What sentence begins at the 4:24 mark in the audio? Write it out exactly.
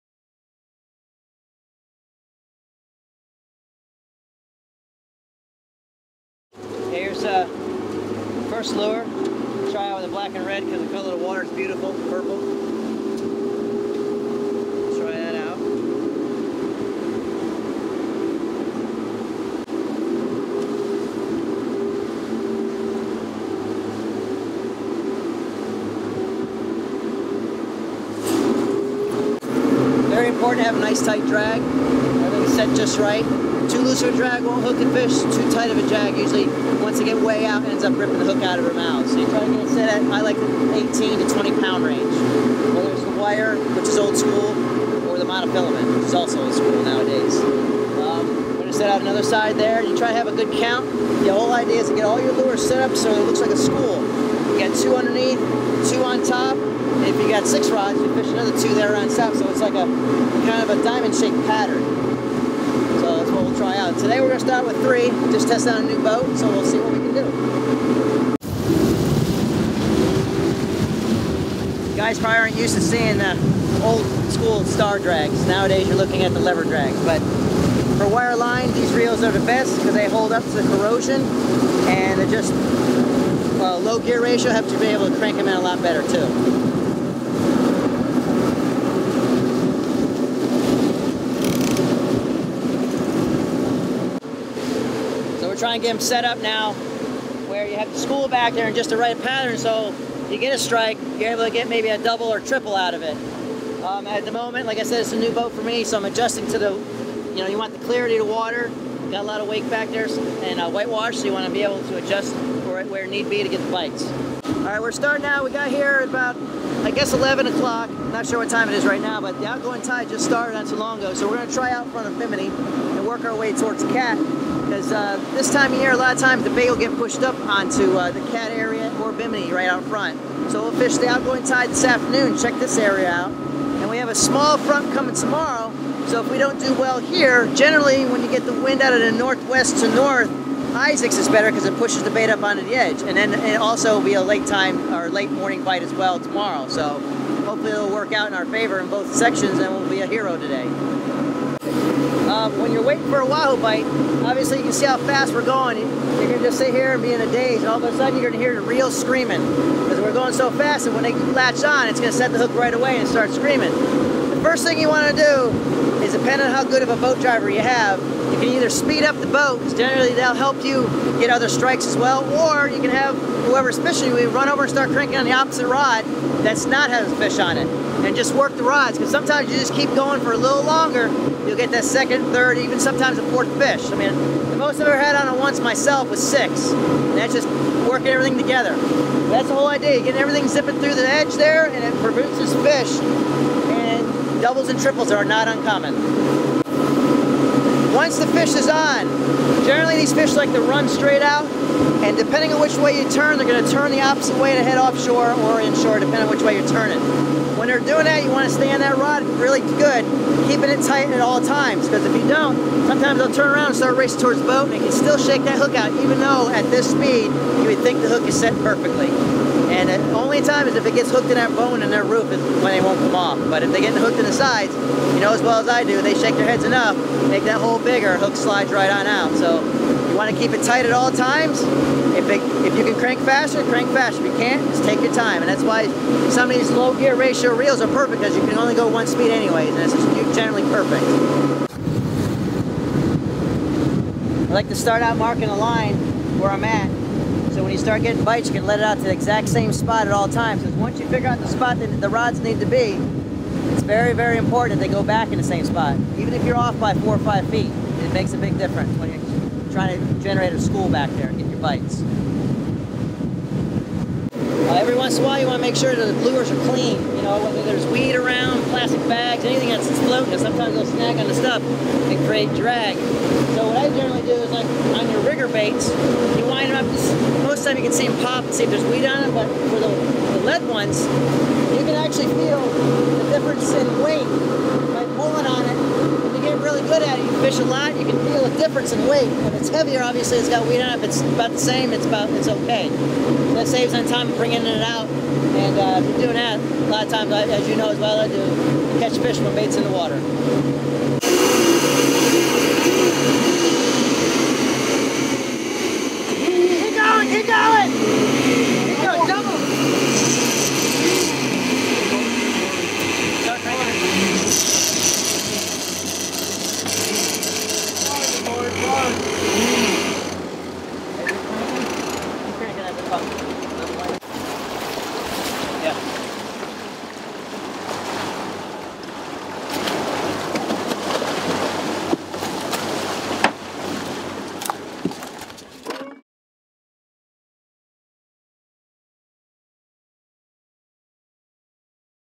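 Uh, every once in a while you want to make sure that the lures are clean.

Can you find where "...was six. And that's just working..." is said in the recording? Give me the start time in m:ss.
3:06.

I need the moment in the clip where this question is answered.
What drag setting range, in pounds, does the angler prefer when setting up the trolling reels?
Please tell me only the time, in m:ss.
0:40.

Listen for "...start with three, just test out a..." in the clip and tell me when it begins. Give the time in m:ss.
1:04.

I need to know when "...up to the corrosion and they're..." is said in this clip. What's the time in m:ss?
1:20.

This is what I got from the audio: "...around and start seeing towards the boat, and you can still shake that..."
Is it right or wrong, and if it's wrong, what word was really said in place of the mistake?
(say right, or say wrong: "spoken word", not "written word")
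wrong: "racing", not "seeing".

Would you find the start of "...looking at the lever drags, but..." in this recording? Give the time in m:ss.
1:15.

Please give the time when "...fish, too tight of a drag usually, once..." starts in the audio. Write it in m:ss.
0:34.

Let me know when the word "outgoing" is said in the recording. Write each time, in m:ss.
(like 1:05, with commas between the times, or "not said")
1:59, 2:11.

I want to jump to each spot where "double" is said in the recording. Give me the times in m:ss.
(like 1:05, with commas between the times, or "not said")
1:41, 3:14.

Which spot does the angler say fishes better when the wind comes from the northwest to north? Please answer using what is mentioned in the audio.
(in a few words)
Isaacs.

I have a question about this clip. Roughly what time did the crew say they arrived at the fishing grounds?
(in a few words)
11 o'clock.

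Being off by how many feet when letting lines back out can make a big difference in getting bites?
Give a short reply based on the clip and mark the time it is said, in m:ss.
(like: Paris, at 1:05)
4 or 5 feet, at 4:16.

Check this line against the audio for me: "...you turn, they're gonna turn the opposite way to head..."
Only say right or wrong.
right.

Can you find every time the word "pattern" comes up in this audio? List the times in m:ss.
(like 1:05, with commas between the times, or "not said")
1:01, 1:39.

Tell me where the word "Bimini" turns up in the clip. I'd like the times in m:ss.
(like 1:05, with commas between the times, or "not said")
2:02, 2:09.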